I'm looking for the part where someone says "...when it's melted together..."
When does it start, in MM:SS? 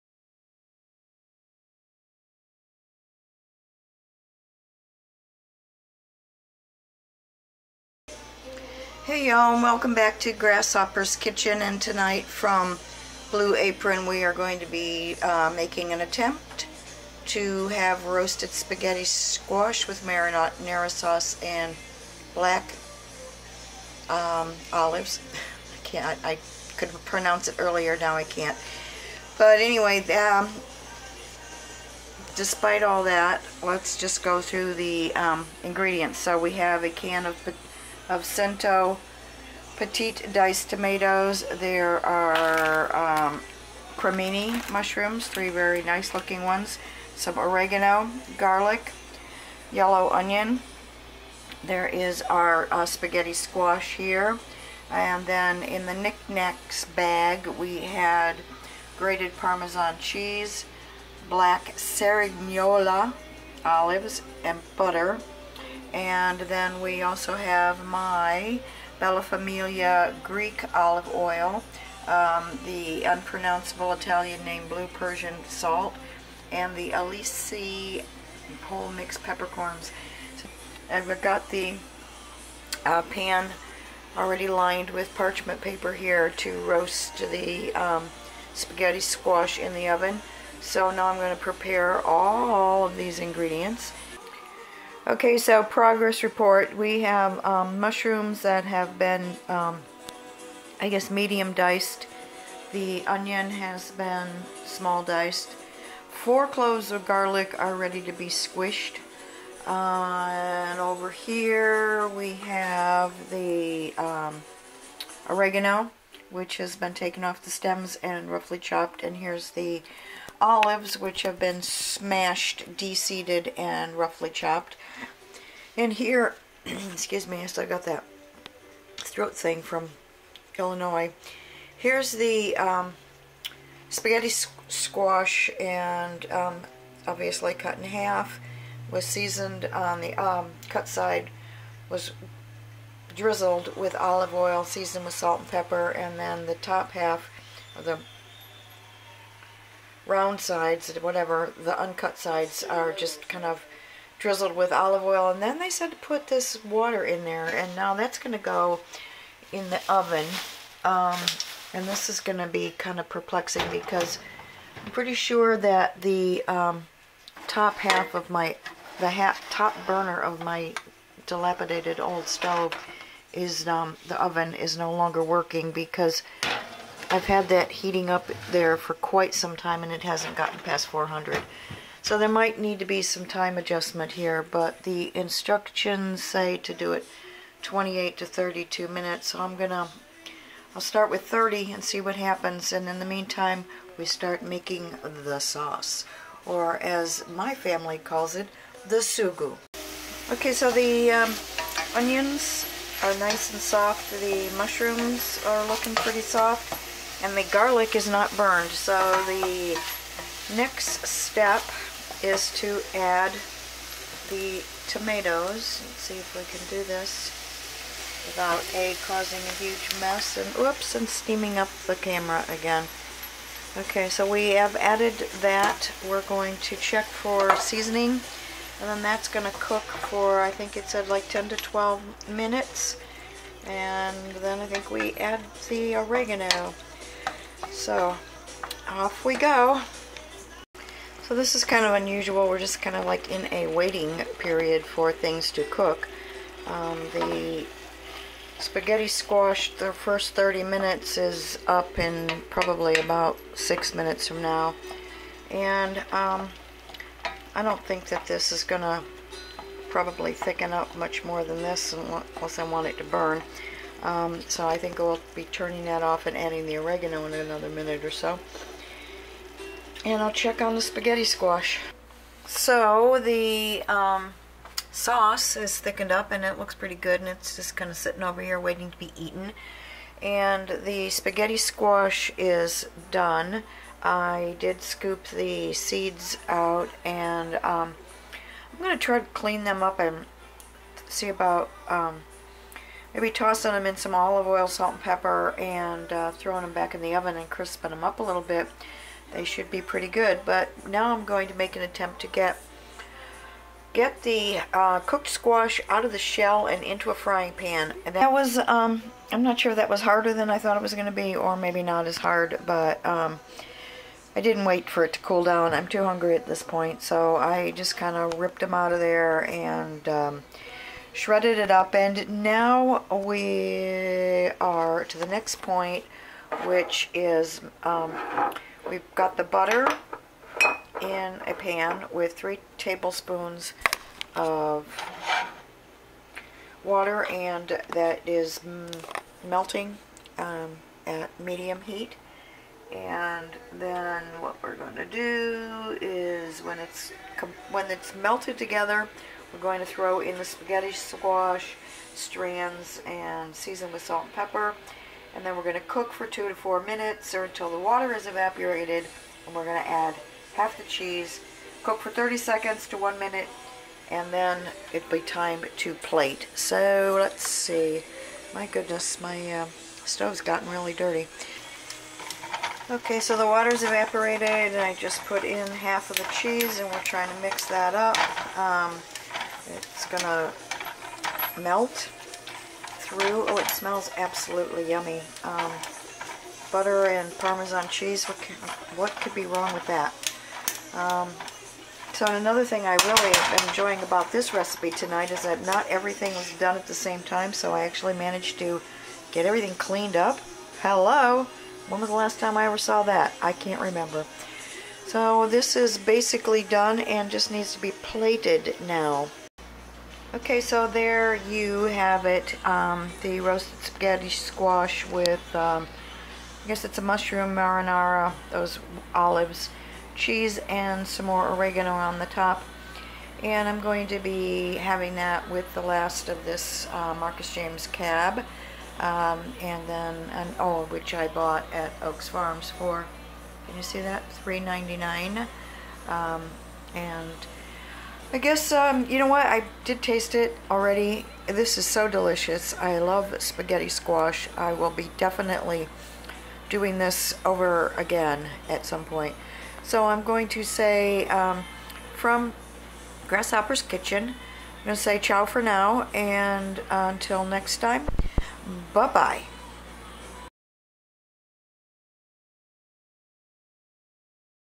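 05:47.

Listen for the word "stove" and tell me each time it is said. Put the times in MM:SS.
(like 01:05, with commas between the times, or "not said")
02:52, 06:10.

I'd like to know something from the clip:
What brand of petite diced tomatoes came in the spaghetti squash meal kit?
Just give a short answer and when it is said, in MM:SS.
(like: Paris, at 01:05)
Cento, at 00:38.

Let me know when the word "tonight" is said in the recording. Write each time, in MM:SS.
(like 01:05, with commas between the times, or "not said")
00:11, 06:34.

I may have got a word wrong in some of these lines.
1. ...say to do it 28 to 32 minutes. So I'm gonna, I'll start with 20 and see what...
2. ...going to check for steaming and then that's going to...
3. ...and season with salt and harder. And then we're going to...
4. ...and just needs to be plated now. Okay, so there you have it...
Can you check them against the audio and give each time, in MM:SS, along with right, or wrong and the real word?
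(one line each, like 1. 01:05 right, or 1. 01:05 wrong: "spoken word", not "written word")
1. 03:06 wrong: "30", not "20"
2. 03:46 wrong: "seasoning", not "steaming"
3. 05:53 wrong: "pepper", not "harder"
4. 06:46 right.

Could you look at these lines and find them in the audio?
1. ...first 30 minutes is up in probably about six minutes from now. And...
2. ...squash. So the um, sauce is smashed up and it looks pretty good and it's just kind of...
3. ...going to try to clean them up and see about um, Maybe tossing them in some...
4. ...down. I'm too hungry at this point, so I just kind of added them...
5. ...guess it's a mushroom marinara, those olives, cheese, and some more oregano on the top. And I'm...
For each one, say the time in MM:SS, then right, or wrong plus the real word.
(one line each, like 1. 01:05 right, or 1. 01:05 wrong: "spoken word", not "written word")
1. 04:09 right
2. 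04:31 wrong: "thickened", not "smashed"
3. 04:48 right
4. 05:15 wrong: "ripped", not "added"
5. 06:56 right.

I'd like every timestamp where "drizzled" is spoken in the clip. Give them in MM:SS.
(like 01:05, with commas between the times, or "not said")
02:23, 02:34.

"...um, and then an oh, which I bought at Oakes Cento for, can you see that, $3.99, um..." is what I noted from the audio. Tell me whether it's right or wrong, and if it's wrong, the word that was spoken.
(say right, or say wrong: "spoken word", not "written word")
wrong: "Farms", not "Cento".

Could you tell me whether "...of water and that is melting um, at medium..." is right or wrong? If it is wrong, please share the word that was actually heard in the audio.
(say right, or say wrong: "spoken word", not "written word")
right.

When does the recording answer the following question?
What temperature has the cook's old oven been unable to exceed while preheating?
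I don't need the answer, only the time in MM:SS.
03:00.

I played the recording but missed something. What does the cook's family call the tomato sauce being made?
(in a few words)
sugu.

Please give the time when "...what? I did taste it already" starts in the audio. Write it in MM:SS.
07:19.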